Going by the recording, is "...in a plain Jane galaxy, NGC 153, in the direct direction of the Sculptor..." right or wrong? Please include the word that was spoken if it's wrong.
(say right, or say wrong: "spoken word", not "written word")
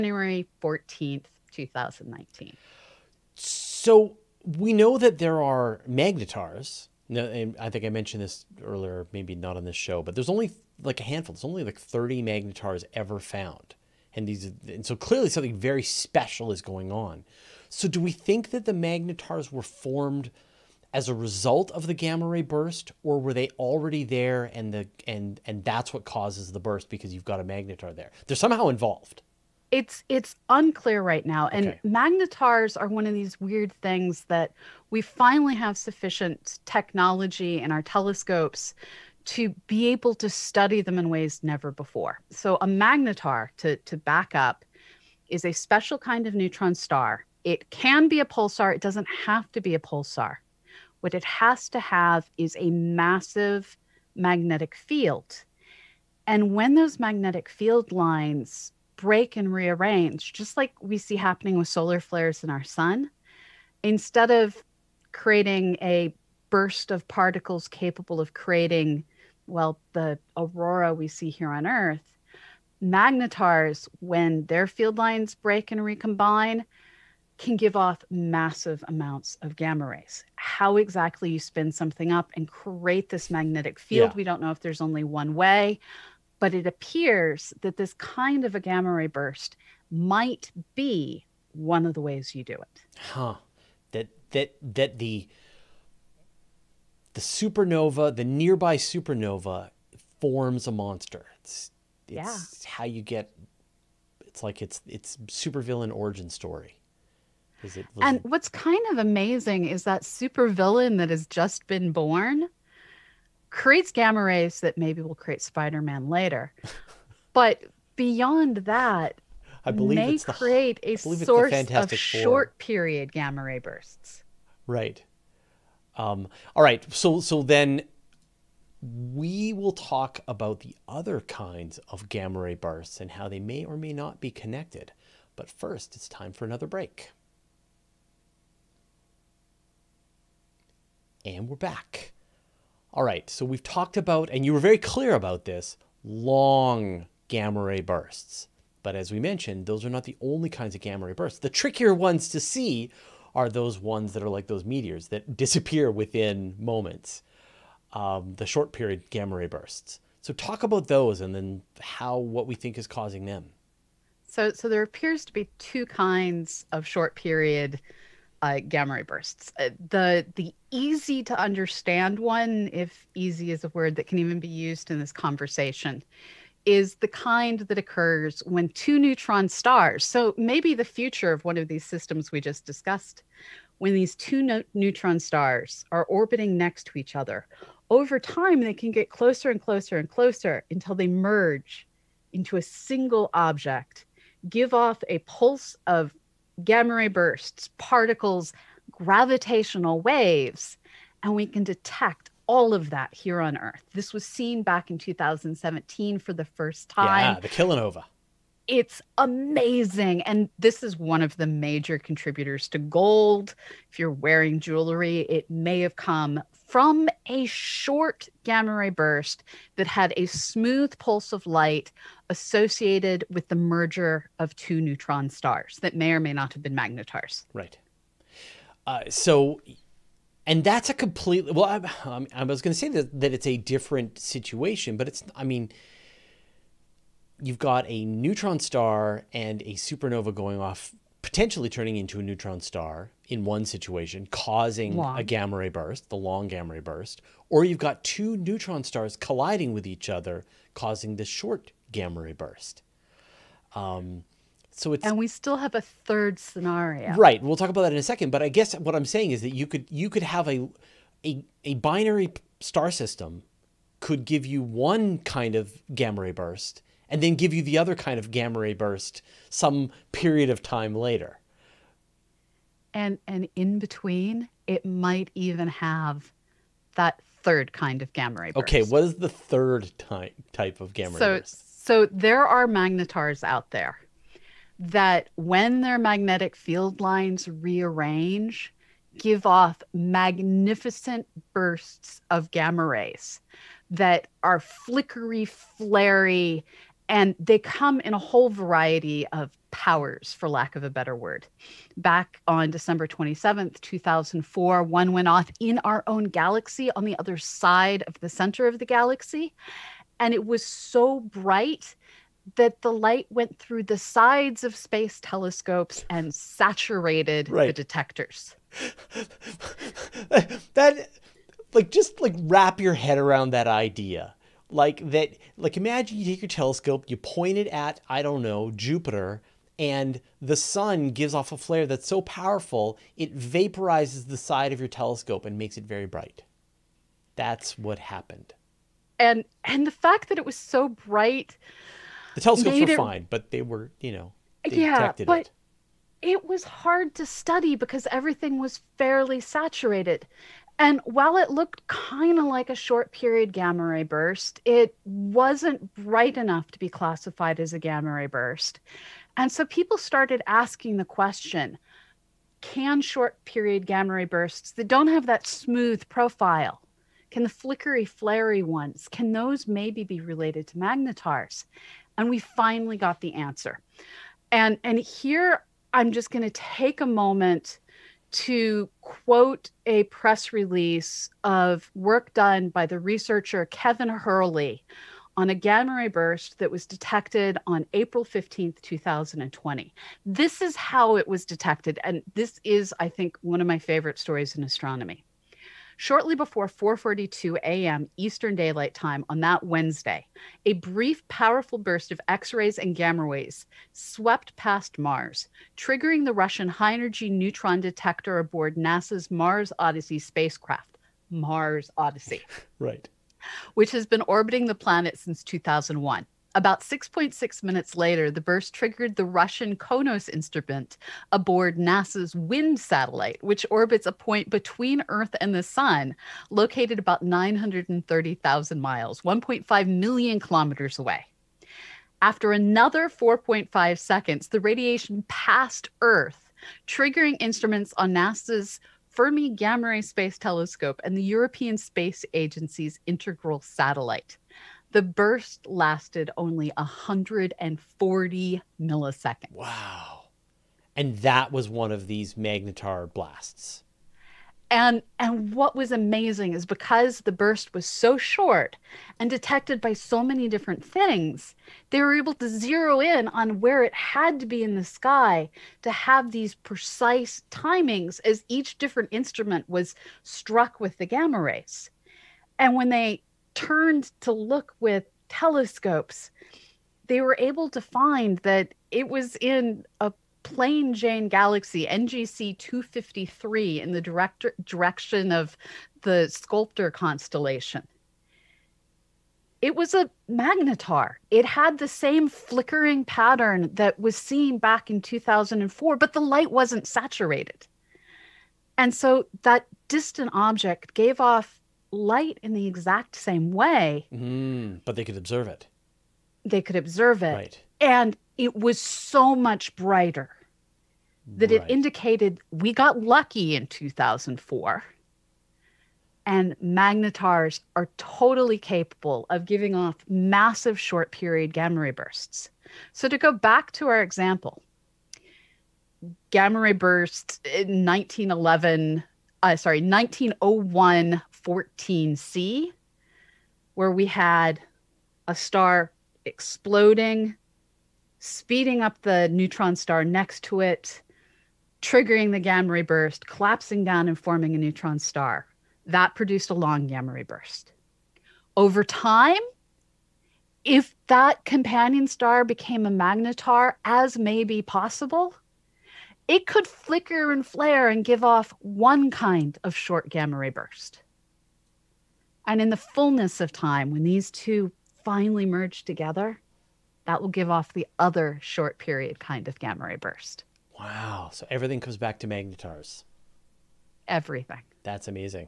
wrong: "253", not "153".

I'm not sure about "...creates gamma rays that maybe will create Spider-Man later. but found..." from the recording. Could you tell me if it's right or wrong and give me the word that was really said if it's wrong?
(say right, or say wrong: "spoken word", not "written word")
wrong: "beyond", not "found".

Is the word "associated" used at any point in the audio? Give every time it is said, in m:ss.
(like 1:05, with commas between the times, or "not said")
3:42.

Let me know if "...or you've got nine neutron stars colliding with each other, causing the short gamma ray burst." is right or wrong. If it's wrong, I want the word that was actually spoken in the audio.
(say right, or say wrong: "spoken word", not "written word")
wrong: "two", not "nine".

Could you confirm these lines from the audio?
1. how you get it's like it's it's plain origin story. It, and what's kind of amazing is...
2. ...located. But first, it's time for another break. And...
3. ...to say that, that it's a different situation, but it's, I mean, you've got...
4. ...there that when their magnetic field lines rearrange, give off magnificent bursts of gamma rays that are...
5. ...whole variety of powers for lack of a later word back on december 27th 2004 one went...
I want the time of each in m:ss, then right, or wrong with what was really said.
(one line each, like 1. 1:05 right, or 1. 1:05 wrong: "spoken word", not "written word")
1. 1:42 wrong: "supervillain", not "plain"
2. 2:14 wrong: "connected", not "located"
3. 3:52 right
4. 4:43 right
5. 4:58 wrong: "better", not "later".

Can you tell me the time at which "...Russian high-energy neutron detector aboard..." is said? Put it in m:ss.
6:46.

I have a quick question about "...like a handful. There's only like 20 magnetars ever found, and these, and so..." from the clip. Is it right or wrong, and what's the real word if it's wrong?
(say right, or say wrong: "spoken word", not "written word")
wrong: "30", not "20".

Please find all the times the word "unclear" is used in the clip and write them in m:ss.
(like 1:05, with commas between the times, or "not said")
0:30.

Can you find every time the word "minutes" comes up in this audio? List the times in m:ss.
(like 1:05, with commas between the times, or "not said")
6:57.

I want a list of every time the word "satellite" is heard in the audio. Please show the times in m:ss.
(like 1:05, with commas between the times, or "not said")
7:02, 7:23.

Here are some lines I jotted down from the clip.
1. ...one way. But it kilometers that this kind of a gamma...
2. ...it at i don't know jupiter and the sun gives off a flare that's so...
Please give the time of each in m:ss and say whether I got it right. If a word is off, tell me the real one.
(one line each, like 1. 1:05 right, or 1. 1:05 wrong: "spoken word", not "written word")
1. 1:25 wrong: "appears", not "kilometers"
2. 5:27 right.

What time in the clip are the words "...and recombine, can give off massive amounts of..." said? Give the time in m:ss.
1:15.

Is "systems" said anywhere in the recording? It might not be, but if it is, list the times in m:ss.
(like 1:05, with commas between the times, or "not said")
3:01, 4:22.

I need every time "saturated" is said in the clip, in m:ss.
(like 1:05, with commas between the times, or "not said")
5:16, 5:49, 8:16.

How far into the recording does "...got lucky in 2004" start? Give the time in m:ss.
8:32.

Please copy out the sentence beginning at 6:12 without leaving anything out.
And we finally got the answer.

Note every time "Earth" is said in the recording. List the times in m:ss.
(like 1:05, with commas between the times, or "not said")
1:11, 3:23, 7:05, 7:16.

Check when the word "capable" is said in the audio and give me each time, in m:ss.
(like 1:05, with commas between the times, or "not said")
1:07, 8:38.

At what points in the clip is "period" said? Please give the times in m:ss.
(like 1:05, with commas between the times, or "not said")
2:02, 2:38, 2:47, 4:30, 5:53, 6:03, 8:41, 9:28.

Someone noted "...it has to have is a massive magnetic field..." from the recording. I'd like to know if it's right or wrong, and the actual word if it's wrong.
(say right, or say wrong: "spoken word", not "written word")
right.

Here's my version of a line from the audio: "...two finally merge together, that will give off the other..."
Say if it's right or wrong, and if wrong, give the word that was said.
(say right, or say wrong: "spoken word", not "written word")
right.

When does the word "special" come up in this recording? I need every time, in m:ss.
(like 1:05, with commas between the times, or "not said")
0:15, 0:45.